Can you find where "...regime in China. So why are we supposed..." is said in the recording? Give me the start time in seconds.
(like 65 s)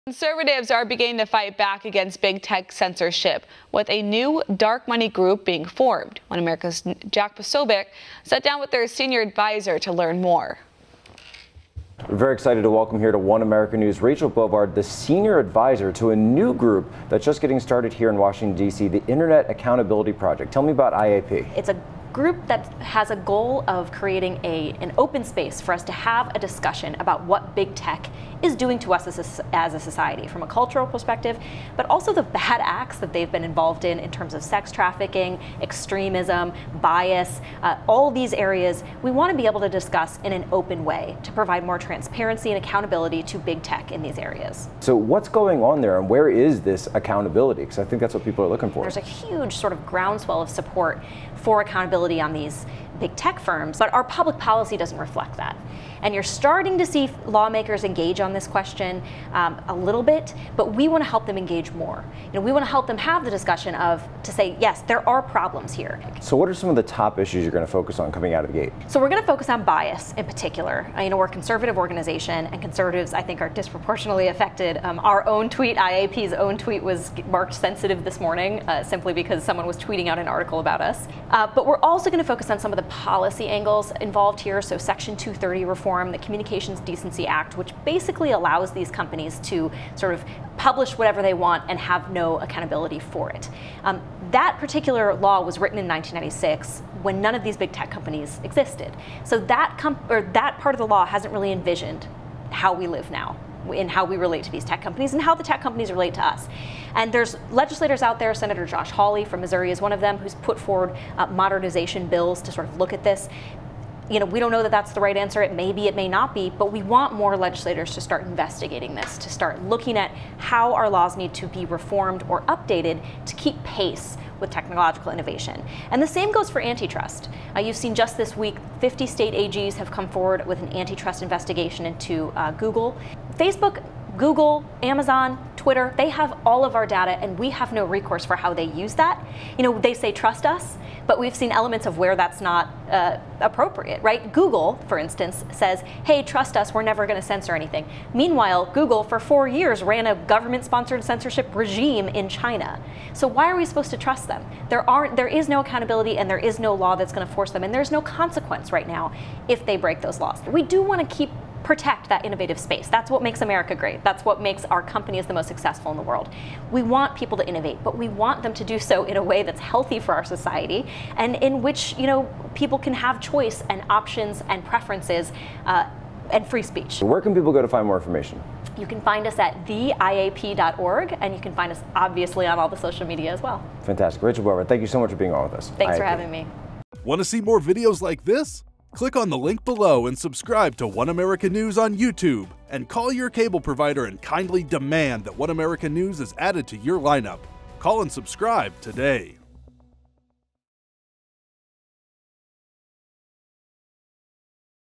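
151 s.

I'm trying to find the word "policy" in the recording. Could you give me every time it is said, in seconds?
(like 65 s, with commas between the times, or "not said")
54 s, 82 s.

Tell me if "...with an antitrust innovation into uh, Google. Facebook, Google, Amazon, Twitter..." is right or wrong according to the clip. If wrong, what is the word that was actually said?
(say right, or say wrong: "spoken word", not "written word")
wrong: "investigation", not "innovation".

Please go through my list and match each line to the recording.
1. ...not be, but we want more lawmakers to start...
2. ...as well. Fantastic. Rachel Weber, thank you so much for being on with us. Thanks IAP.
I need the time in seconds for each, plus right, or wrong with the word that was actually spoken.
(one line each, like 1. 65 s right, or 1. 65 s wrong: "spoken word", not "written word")
1. 116 s wrong: "legislators", not "lawmakers"
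2. 183 s right.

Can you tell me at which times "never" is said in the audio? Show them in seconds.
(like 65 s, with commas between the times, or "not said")
146 s.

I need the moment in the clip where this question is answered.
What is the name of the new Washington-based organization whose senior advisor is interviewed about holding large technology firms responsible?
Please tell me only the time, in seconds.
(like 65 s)
19 s.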